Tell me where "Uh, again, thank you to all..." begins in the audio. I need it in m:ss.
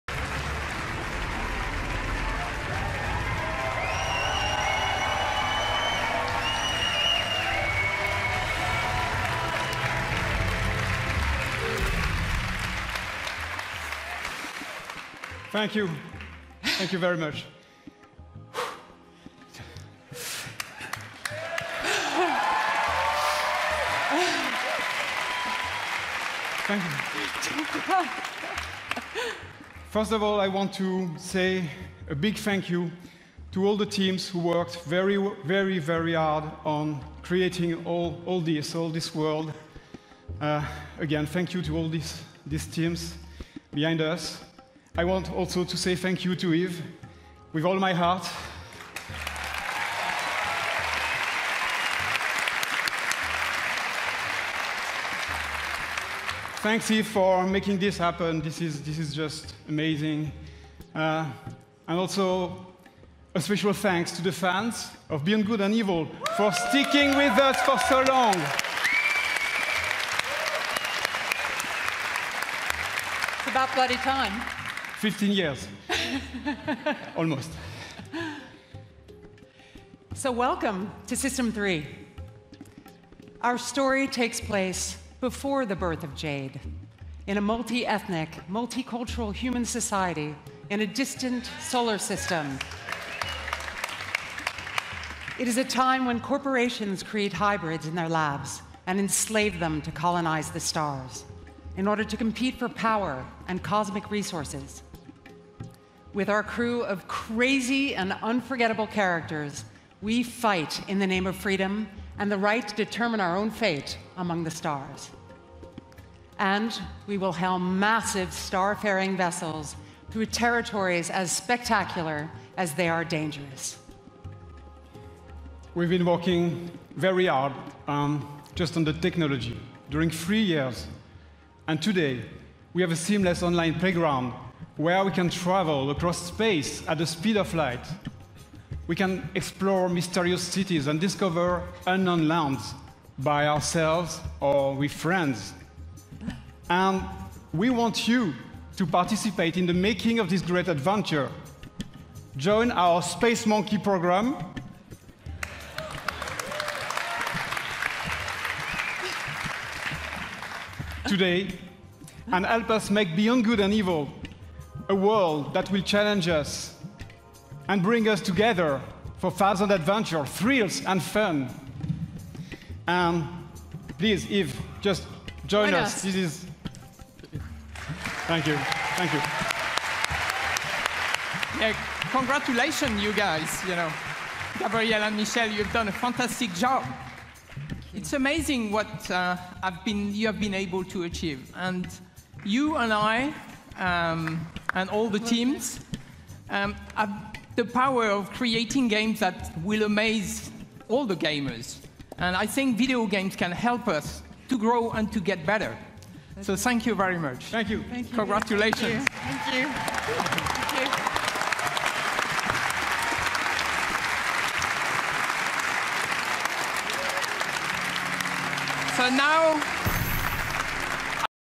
0:40.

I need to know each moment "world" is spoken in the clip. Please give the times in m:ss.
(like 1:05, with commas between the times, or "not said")
0:39, 2:44.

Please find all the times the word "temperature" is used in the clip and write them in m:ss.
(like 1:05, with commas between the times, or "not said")
not said.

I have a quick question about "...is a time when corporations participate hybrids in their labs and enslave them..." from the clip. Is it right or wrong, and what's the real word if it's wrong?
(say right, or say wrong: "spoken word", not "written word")
wrong: "create", not "participate".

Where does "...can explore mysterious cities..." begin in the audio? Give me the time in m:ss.
2:18.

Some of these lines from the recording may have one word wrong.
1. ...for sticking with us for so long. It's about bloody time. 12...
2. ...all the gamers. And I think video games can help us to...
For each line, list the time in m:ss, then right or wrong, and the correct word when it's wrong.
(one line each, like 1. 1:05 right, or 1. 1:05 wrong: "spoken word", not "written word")
1. 1:06 wrong: "15", not "12"
2. 3:20 right.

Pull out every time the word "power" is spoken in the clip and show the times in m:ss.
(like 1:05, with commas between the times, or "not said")
1:42, 3:17.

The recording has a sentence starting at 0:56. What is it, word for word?
Thanks, Yves, for making this happen.